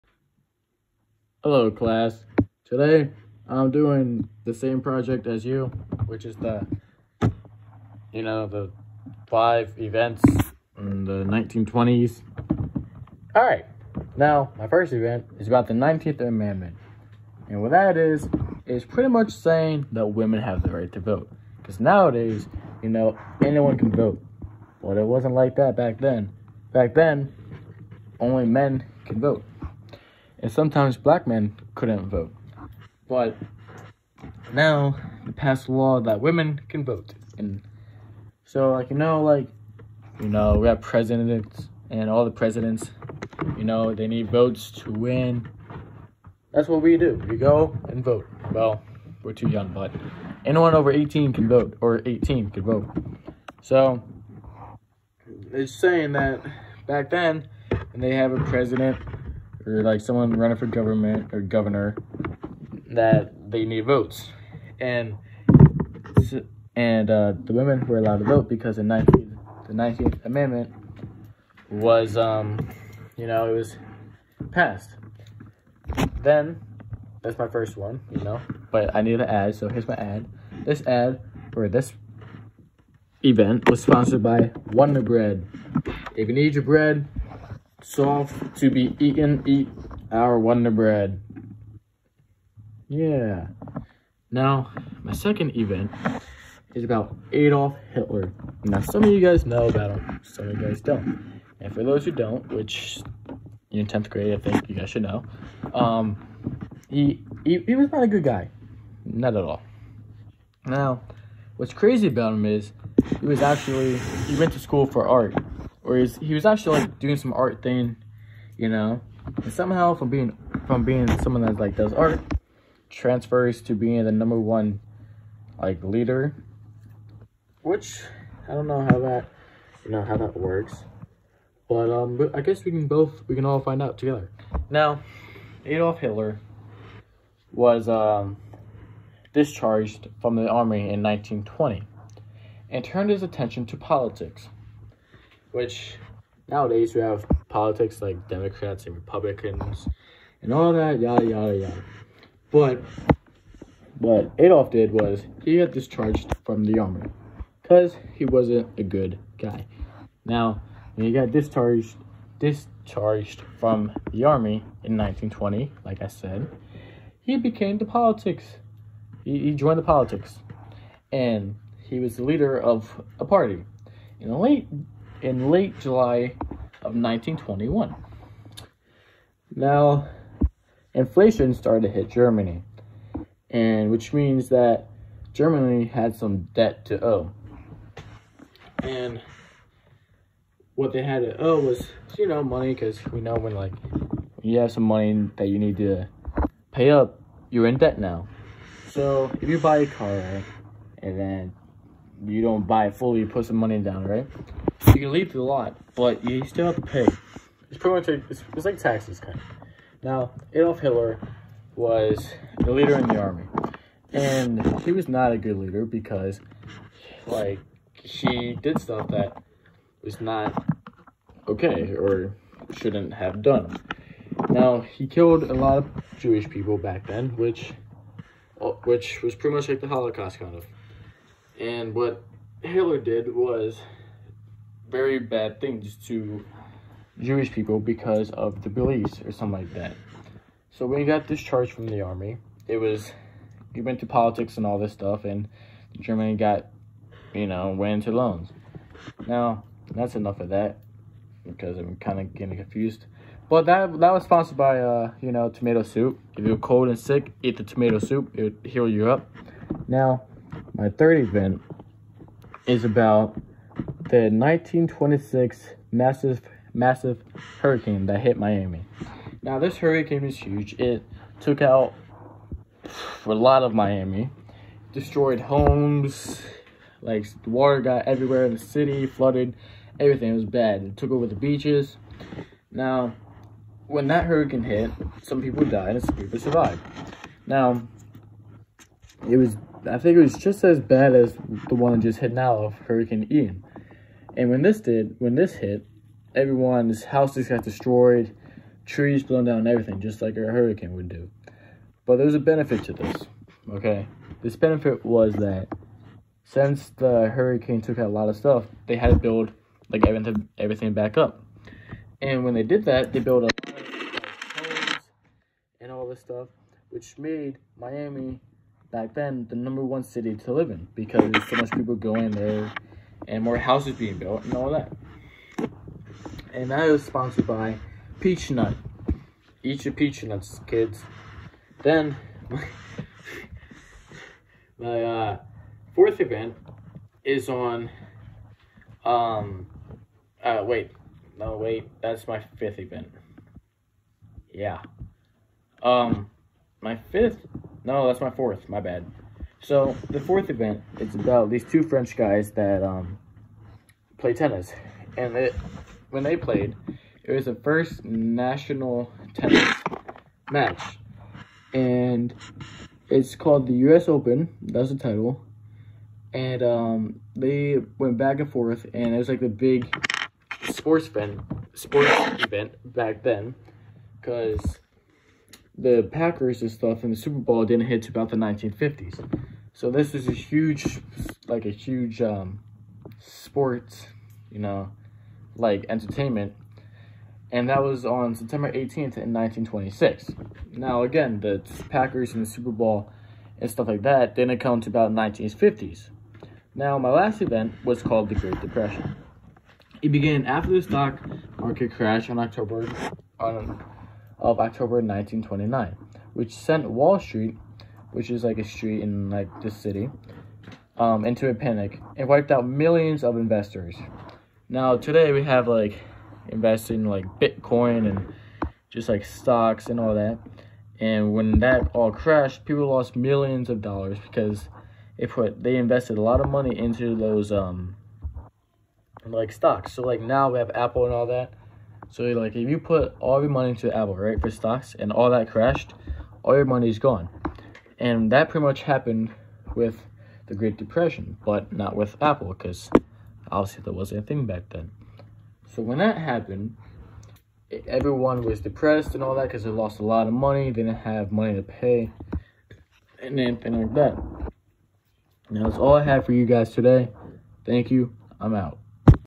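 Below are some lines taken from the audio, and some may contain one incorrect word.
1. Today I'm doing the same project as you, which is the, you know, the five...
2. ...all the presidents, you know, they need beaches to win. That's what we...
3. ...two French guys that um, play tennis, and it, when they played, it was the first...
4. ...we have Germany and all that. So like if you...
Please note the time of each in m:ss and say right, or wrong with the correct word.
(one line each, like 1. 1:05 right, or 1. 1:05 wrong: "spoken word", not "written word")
1. 0:02 right
2. 0:42 wrong: "votes", not "beaches"
3. 5:51 right
4. 7:10 wrong: "Apple", not "Germany".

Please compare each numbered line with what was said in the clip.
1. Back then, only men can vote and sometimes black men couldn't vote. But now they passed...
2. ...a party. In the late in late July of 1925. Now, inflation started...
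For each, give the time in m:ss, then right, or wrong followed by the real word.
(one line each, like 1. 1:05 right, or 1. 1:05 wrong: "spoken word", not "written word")
1. 0:26 right
2. 2:53 wrong: "1921", not "1925".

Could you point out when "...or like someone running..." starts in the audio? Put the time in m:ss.
0:59.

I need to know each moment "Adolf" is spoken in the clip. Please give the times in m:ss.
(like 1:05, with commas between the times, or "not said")
1:37, 2:15, 2:34, 3:30.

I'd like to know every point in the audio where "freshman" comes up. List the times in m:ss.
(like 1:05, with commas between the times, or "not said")
not said.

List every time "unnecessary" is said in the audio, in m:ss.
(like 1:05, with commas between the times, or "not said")
not said.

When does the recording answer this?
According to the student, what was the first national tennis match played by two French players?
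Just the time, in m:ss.
6:03.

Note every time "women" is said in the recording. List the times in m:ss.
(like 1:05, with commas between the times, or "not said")
0:20, 0:36, 1:07.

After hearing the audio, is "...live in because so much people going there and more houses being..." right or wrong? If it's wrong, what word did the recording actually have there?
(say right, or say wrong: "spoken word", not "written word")
right.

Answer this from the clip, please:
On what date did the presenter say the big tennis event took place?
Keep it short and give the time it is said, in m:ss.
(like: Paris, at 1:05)
September 18th, 1926, at 6:28.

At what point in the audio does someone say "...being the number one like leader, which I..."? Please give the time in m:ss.
2:03.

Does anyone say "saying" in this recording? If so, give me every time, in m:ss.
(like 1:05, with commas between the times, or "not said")
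0:19, 0:55.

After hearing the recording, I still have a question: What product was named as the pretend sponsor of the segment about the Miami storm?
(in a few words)
Peach Nut.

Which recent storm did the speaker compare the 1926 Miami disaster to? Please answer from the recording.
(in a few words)
Hurricane Ian.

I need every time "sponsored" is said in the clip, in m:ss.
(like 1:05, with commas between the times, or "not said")
1:23, 4:14, 5:27.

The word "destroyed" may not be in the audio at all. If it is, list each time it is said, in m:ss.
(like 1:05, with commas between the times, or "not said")
4:34, 4:57.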